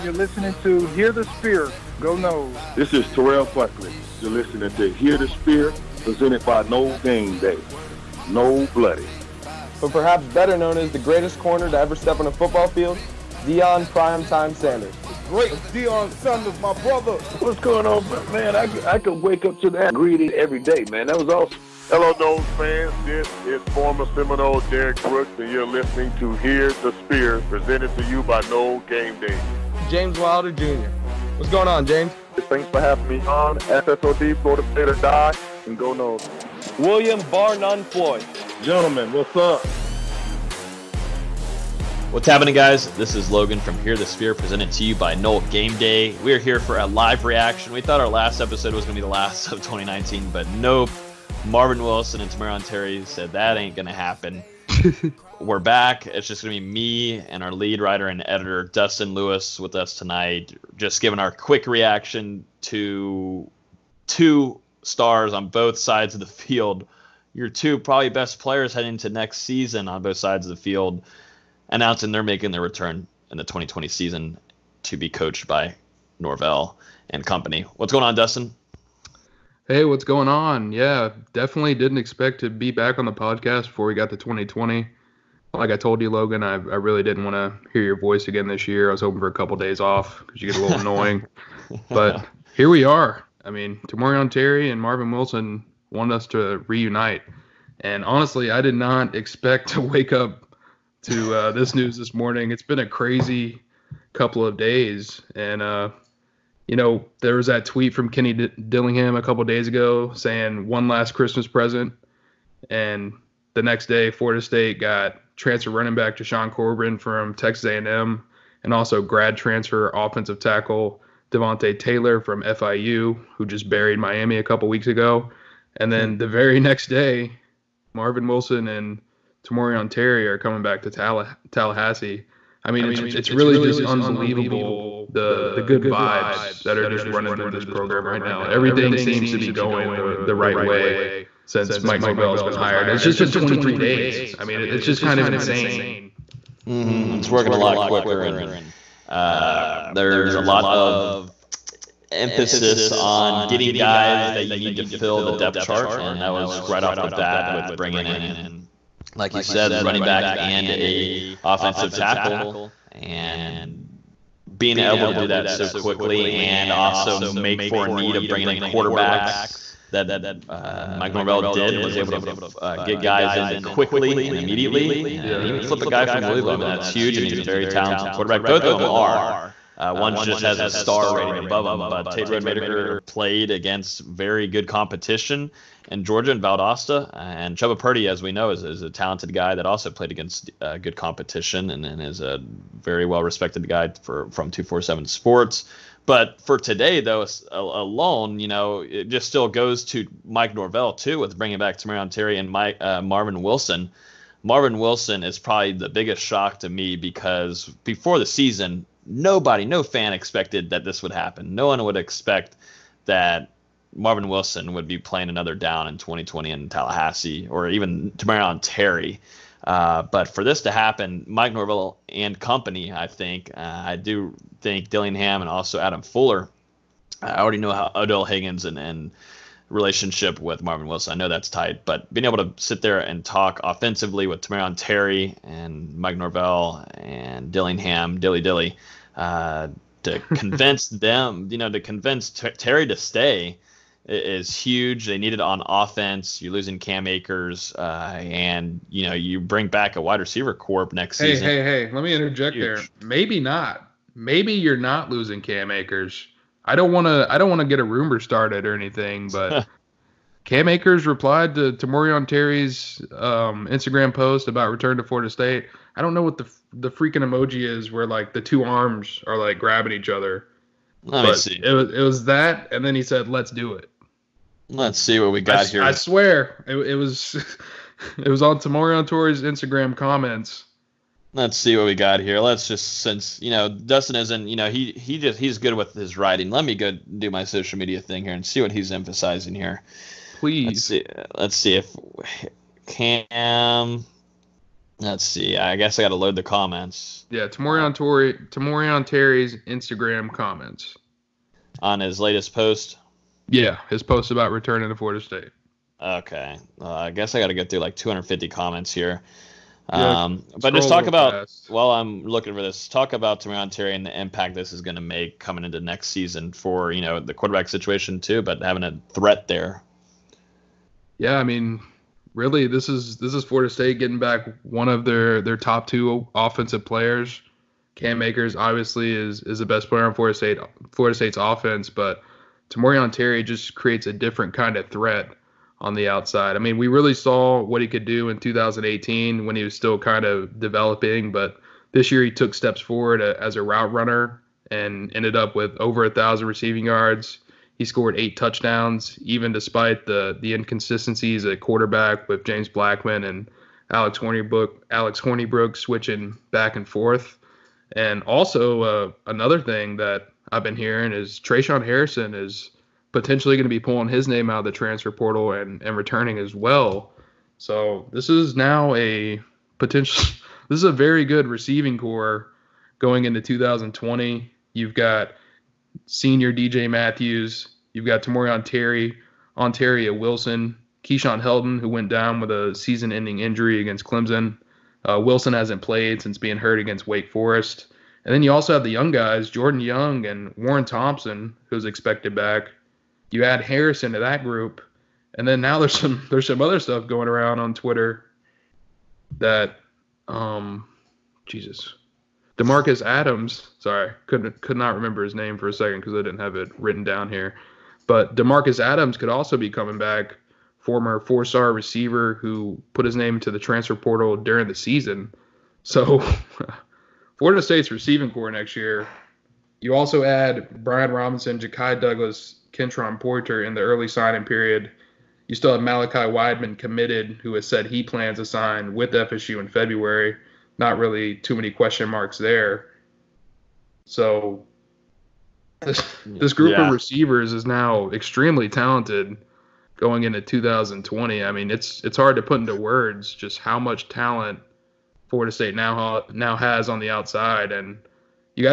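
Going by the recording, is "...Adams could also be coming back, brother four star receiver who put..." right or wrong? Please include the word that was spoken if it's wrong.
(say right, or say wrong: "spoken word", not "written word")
wrong: "former", not "brother".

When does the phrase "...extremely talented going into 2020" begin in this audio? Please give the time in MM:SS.
07:18.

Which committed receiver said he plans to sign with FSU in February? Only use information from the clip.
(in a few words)
Malachi Wideman.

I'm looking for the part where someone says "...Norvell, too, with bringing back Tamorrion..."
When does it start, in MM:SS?
03:20.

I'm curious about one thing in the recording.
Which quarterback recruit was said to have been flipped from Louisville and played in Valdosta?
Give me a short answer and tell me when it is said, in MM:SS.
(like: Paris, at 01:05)
Tate Rodemaker, at 03:02.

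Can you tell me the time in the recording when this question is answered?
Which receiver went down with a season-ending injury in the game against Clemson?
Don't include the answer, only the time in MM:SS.
06:21.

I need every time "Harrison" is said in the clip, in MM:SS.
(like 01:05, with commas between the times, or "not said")
06:01, 06:33.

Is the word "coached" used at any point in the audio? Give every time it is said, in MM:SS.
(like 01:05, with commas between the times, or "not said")
01:15.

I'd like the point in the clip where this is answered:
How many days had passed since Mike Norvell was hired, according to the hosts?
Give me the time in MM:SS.
02:23.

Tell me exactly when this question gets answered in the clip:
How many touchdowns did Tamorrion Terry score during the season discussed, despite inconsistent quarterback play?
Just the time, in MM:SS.
05:48.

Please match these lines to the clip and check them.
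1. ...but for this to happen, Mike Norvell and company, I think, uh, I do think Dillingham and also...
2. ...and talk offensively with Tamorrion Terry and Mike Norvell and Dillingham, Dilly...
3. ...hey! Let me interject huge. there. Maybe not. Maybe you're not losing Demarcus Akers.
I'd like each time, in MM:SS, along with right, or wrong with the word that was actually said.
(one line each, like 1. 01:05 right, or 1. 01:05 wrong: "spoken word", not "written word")
1. 03:40 right
2. 03:52 right
3. 04:11 wrong: "Cam", not "Demarcus".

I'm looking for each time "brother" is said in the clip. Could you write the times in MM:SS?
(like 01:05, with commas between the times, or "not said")
00:16.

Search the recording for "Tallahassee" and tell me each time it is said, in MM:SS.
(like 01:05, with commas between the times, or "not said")
02:11, 03:36.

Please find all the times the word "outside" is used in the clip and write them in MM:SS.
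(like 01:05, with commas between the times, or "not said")
05:36, 07:27.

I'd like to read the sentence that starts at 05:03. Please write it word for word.
Yeah, his post about returning to Florida State.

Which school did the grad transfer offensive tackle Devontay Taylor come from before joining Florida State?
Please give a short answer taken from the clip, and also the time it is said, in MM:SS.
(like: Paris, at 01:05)
FIU, at 02:02.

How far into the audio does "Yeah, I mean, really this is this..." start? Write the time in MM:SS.
05:21.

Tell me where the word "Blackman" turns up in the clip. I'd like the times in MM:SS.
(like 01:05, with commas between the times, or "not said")
05:52.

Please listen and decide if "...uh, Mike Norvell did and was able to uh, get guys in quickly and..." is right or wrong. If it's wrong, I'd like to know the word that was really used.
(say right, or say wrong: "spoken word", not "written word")
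right.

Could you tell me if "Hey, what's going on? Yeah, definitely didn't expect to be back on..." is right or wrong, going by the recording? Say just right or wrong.
right.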